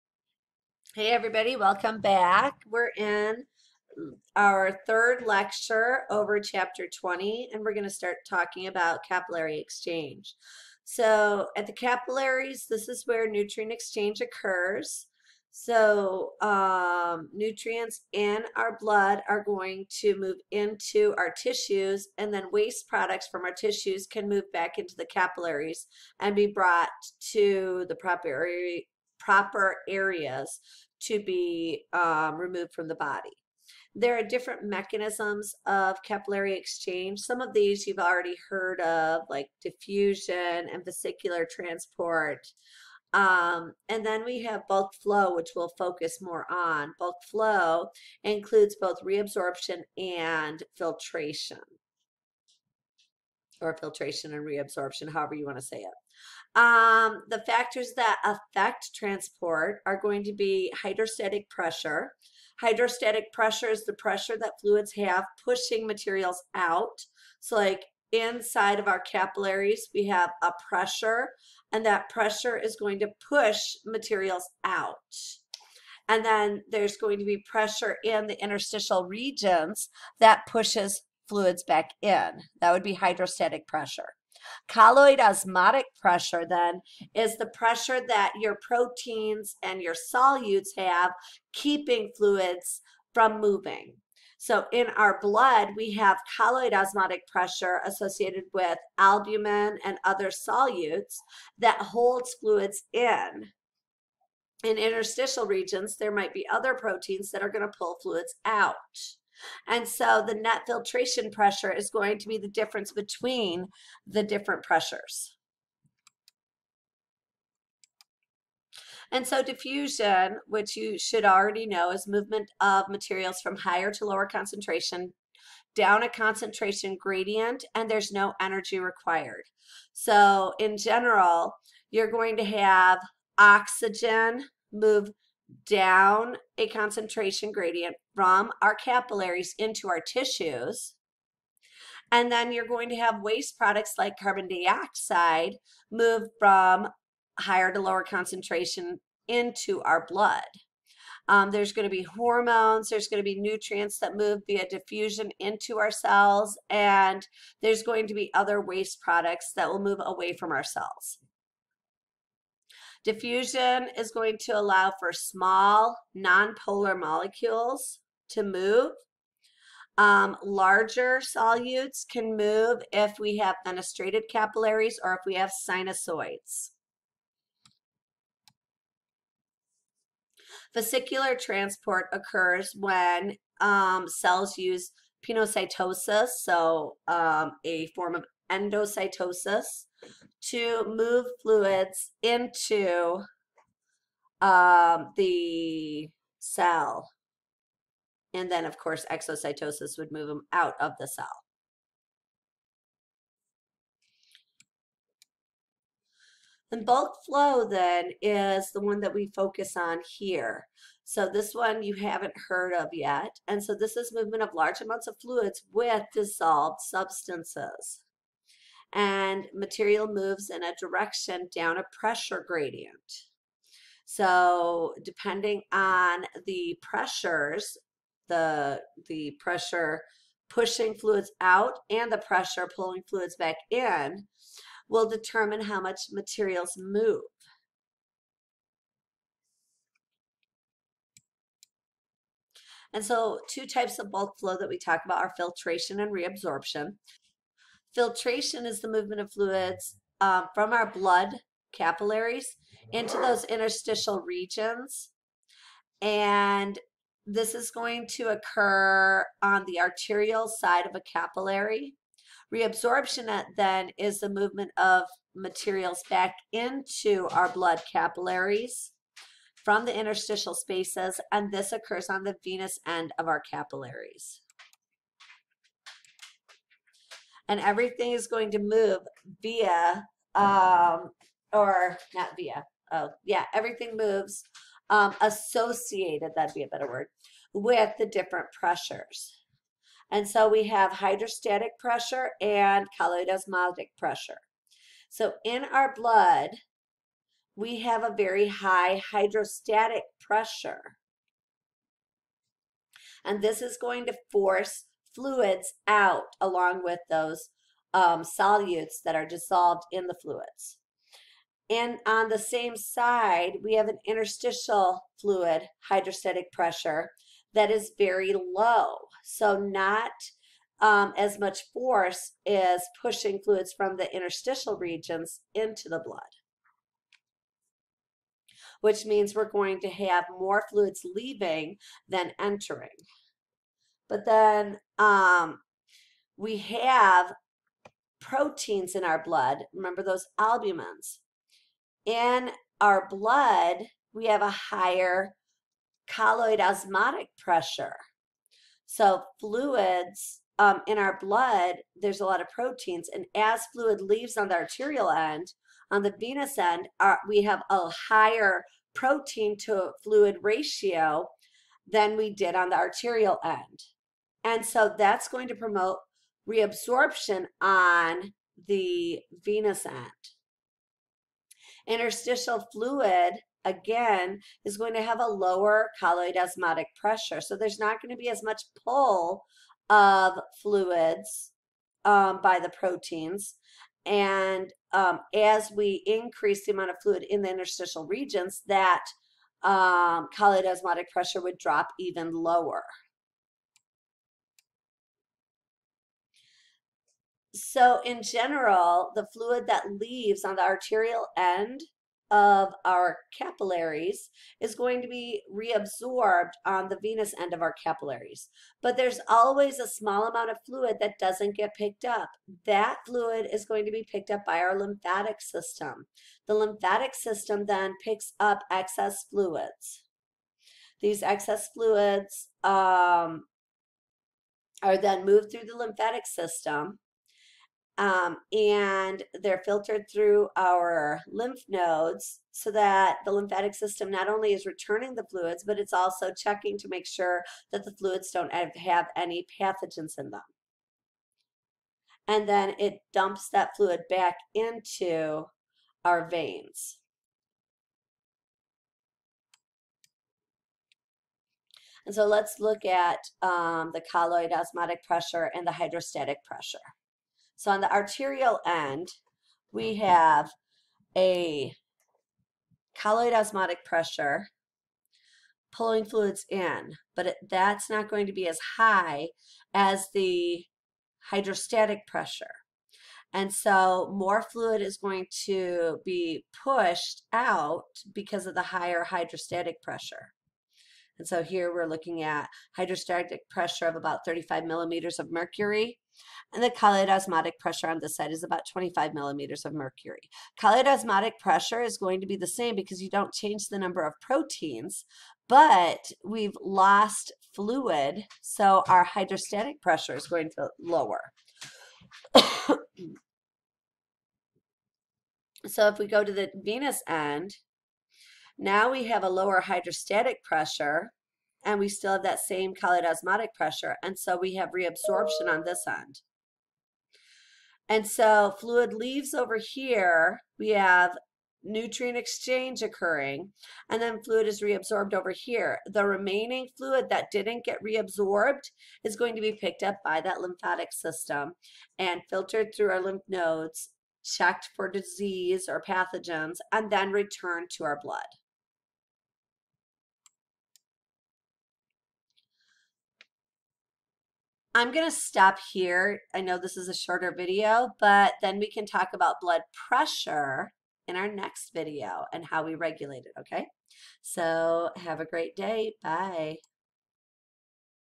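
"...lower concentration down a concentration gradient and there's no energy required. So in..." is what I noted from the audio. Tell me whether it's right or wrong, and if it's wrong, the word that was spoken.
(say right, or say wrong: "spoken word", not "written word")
right.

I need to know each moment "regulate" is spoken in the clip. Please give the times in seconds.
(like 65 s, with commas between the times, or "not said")
552 s.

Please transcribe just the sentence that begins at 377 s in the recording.
So there's not going to be as much pull of fluids um, by the proteins.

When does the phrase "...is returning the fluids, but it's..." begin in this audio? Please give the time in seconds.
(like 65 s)
434 s.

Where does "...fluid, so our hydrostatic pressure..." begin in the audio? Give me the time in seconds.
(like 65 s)
497 s.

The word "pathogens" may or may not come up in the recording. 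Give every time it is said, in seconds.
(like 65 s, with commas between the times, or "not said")
439 s, 535 s.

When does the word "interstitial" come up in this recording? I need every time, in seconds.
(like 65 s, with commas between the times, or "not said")
78 s, 104 s, 253 s, 269 s, 314 s, 324 s, 371 s, 387 s.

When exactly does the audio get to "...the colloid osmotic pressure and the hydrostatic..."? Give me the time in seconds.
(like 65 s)
453 s.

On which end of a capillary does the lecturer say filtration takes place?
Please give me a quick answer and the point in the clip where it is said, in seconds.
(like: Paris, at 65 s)
arterial side, at 259 s.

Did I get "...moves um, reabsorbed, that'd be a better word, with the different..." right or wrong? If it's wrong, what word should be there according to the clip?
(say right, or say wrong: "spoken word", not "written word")
wrong: "associated", not "reabsorbed".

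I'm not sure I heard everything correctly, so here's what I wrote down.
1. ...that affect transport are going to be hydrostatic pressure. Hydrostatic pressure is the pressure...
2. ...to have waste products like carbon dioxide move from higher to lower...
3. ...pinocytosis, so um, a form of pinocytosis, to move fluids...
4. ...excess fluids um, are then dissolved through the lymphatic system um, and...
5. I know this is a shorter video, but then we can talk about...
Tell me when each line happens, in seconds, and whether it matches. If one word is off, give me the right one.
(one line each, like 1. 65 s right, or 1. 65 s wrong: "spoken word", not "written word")
1. 57 s right
2. 142 s right
3. 185 s wrong: "endocytosis", not "pinocytosis"
4. 421 s wrong: "moved", not "dissolved"
5. 546 s right.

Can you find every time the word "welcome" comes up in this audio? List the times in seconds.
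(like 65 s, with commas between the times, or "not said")
1 s.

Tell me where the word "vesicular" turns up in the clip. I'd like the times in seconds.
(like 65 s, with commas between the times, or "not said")
40 s, 180 s.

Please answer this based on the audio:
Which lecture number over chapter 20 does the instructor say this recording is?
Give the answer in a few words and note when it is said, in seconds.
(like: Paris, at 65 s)
third, at 4 s.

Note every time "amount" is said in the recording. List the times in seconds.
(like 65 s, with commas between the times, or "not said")
214 s, 386 s, 410 s.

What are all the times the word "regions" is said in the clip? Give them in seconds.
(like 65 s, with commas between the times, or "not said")
79 s, 105 s, 254 s, 324 s, 388 s.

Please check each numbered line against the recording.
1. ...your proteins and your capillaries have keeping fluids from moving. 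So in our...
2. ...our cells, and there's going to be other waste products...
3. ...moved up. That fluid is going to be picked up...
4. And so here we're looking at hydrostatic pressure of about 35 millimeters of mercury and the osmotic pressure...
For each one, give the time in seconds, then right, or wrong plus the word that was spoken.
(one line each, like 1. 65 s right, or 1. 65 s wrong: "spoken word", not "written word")
1. 88 s wrong: "solutes", not "capillaries"
2. 155 s right
3. 411 s wrong: "picked", not "moved"
4. 481 s right.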